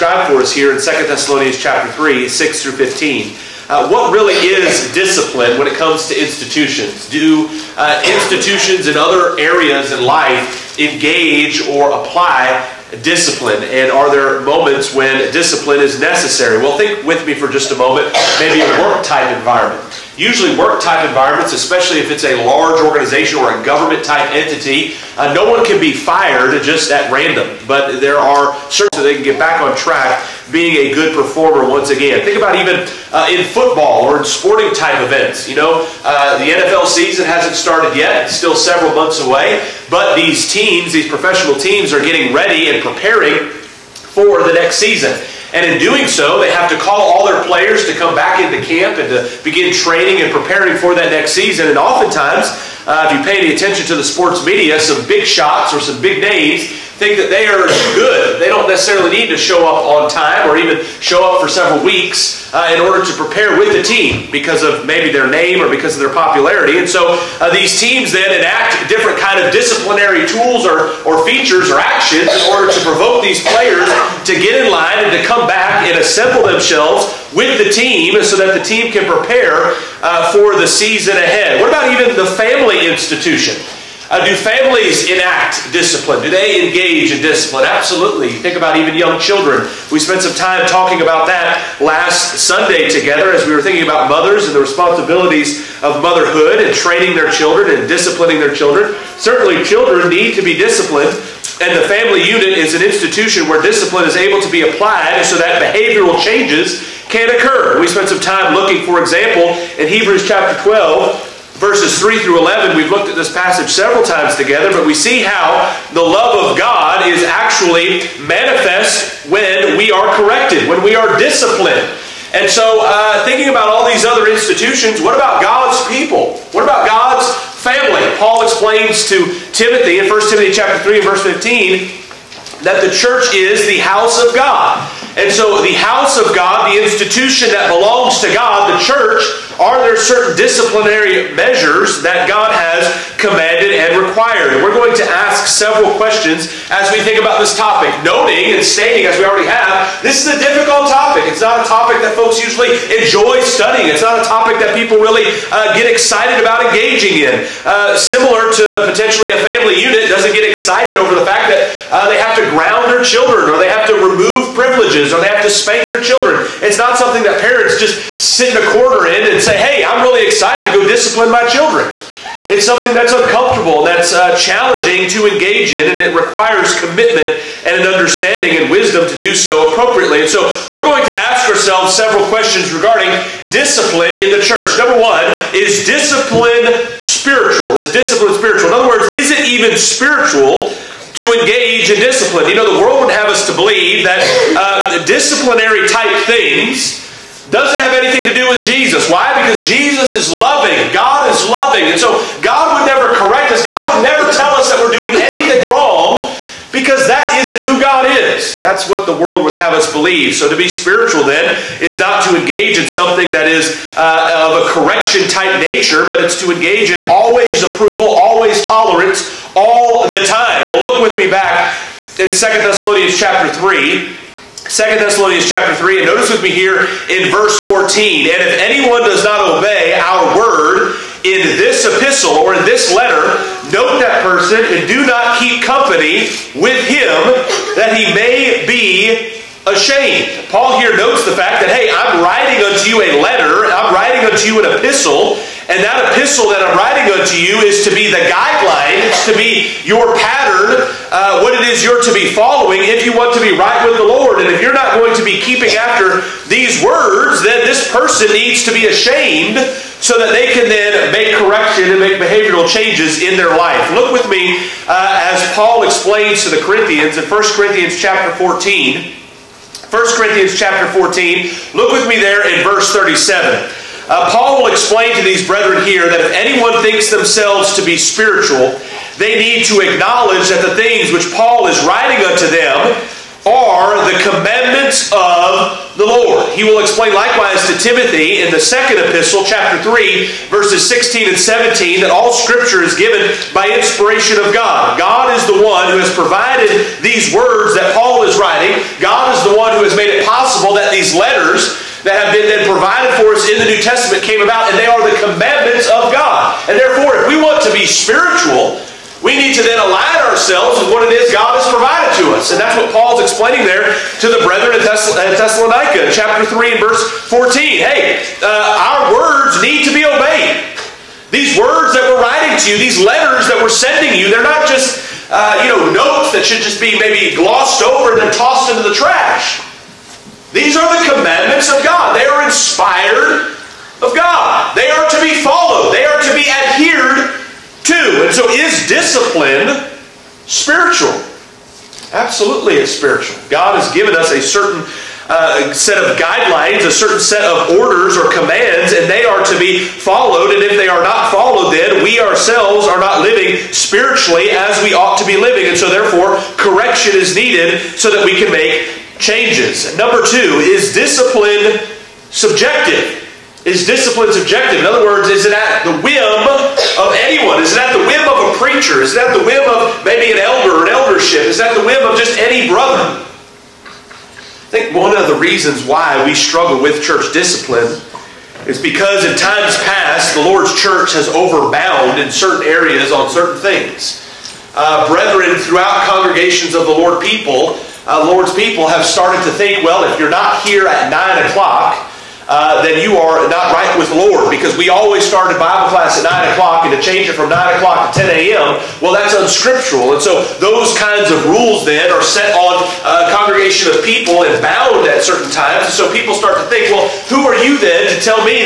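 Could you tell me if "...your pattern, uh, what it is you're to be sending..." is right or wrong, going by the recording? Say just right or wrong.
wrong.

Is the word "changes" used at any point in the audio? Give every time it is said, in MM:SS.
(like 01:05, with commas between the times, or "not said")
01:46, 04:22, 05:59, 06:36.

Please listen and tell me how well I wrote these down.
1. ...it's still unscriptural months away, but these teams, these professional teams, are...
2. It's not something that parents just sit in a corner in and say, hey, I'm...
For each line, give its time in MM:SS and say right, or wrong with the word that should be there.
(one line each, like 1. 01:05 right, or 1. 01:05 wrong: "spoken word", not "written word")
1. 00:38 wrong: "several", not "unscriptural"
2. 02:46 right.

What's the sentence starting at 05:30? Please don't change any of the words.
These are the commandments of God.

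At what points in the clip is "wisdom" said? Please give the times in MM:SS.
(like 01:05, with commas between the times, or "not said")
02:58.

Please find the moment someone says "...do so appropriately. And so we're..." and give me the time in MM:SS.
02:59.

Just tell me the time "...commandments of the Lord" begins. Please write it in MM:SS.
04:44.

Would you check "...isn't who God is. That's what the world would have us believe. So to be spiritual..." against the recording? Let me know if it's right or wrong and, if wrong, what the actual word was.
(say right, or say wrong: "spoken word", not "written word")
right.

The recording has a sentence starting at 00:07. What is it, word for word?
Do uh, institutions and other areas in life engage or apply discipline?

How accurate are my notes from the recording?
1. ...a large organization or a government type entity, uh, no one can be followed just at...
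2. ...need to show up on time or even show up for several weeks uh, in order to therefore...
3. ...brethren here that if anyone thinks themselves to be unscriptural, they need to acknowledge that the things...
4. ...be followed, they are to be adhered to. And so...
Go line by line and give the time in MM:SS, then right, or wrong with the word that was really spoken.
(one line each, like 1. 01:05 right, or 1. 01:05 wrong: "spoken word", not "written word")
1. 00:22 wrong: "fired", not "followed"
2. 00:59 wrong: "prepare", not "therefore"
3. 04:35 wrong: "spiritual", not "unscriptural"
4. 05:35 right.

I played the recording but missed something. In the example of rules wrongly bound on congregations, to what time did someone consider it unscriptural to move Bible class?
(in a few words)
10 a.m.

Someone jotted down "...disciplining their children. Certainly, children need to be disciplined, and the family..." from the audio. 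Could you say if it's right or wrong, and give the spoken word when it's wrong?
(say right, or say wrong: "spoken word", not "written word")
right.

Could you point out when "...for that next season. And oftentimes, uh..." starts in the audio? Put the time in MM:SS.
00:50.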